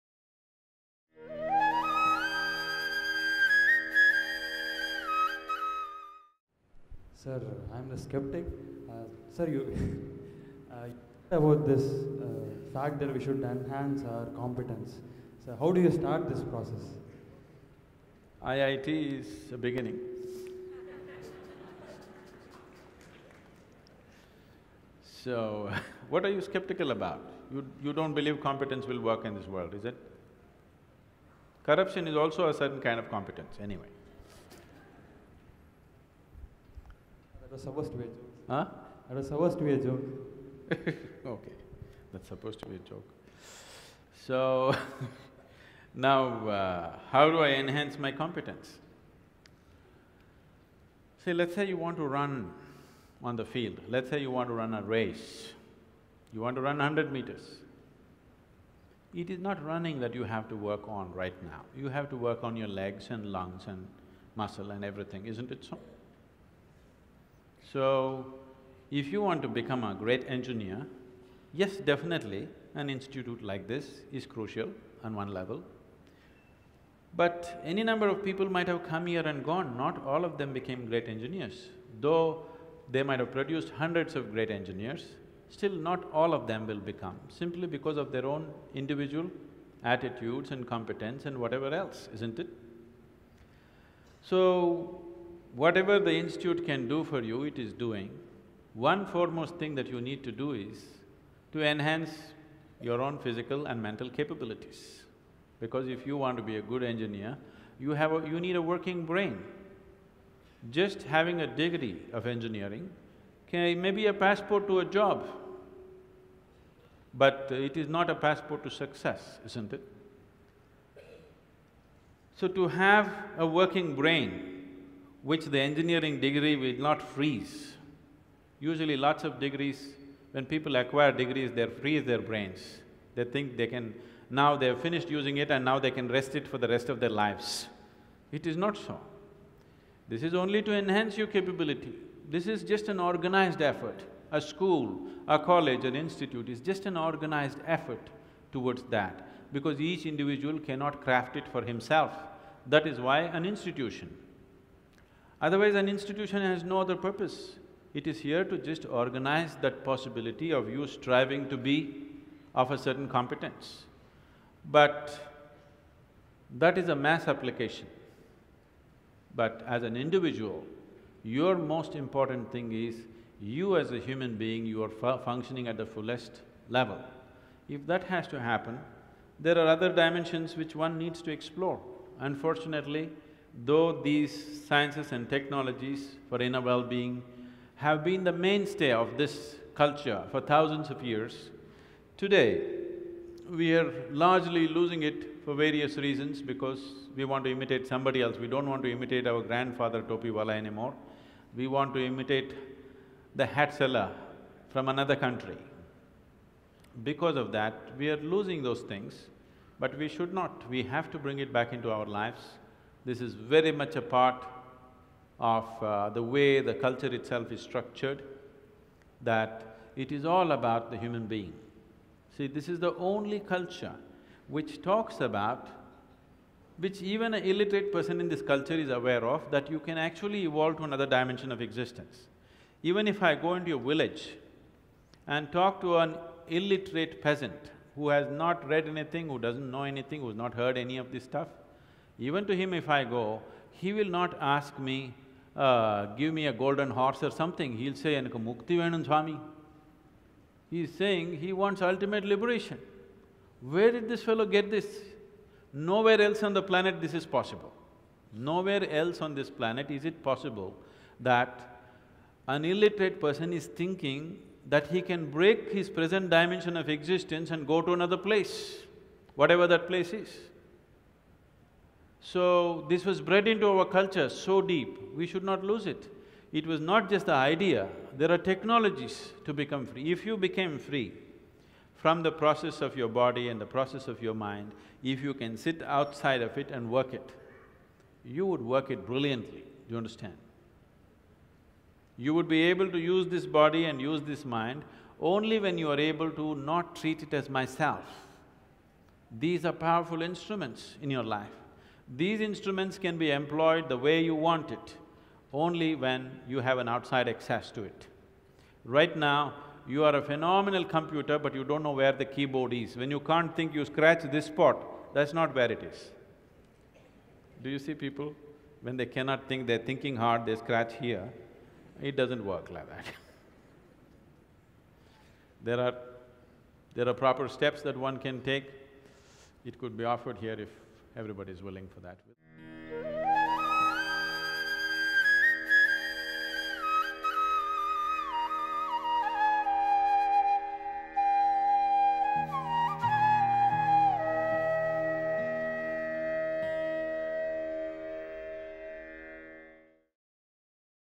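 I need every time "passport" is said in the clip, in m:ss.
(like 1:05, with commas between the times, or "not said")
1:54, 1:58.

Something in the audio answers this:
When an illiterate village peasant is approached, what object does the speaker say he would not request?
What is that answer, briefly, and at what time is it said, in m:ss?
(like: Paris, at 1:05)
a golden horse, at 4:06.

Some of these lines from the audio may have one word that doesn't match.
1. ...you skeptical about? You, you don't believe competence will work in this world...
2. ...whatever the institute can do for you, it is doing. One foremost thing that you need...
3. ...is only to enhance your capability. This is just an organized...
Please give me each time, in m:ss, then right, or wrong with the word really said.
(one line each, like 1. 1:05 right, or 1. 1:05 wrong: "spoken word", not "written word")
1. 0:26 right
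2. 1:35 right
3. 2:20 right.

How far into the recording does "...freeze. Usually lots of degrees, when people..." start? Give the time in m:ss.
2:07.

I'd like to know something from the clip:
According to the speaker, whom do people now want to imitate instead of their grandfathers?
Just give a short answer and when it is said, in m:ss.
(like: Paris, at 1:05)
the hat seller, at 3:23.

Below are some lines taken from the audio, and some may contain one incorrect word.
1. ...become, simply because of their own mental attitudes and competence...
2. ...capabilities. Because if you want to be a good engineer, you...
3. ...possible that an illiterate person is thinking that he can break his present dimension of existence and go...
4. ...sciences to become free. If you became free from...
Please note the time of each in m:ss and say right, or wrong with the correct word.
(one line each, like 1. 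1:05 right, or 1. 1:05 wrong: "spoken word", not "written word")
1. 1:26 wrong: "individual", not "mental"
2. 1:44 right
3. 4:20 right
4. 4:38 wrong: "technologies", not "sciences".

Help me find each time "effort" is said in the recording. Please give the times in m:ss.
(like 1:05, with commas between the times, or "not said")
2:23, 2:27.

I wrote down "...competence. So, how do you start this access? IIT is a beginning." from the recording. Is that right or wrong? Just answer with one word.
wrong.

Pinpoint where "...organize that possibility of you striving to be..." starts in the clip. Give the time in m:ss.
2:38.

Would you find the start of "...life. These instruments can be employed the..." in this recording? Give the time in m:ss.
5:01.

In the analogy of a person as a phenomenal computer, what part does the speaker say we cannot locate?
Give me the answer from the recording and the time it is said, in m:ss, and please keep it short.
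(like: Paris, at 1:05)
the keyboard, at 5:12.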